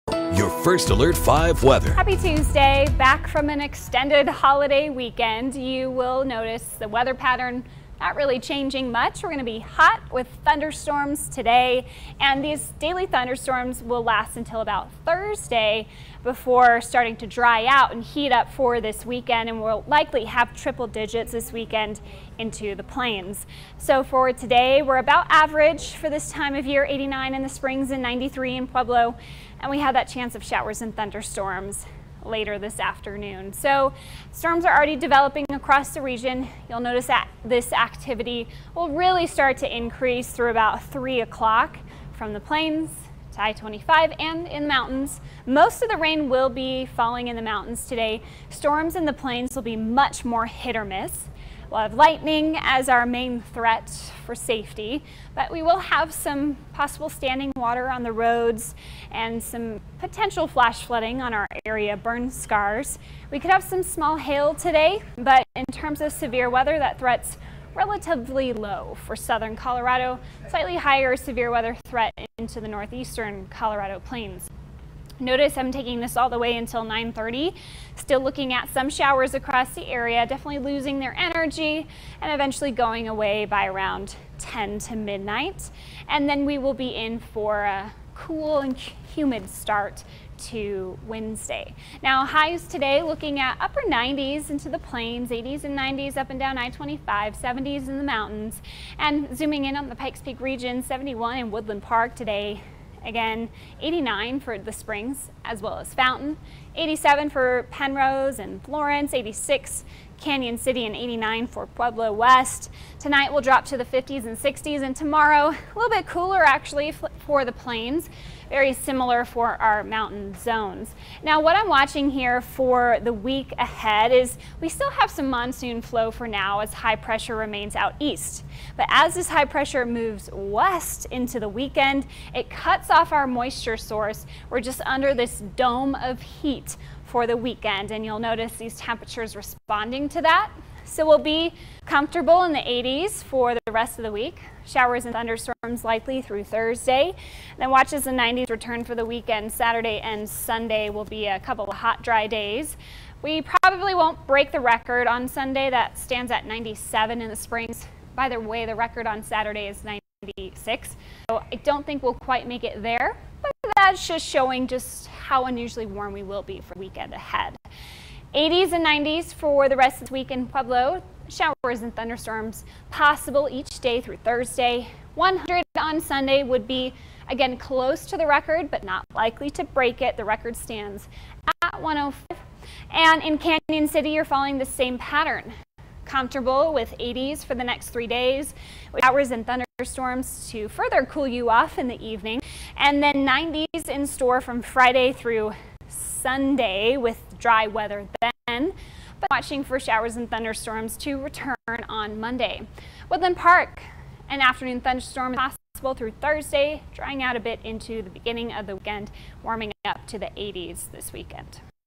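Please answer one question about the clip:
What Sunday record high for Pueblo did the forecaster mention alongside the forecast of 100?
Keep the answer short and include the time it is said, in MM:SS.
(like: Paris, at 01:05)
105, at 03:01.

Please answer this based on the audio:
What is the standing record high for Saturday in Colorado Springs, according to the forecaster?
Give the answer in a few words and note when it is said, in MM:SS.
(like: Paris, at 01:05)
96, at 02:38.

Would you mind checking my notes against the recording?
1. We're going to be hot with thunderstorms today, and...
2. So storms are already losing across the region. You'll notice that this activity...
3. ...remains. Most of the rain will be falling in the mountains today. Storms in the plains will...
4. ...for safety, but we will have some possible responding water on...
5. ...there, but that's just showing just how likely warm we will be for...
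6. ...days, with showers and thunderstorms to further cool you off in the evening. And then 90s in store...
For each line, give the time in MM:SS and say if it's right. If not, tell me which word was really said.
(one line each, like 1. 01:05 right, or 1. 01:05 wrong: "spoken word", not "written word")
1. 00:09 right
2. 00:33 wrong: "developing", not "losing"
3. 00:44 wrong: "mountains", not "remains"
4. 00:54 wrong: "standing", not "responding"
5. 02:42 wrong: "unusually", not "likely"
6. 03:08 right.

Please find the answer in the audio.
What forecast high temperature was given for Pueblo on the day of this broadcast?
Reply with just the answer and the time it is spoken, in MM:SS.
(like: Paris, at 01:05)
93, at 00:28.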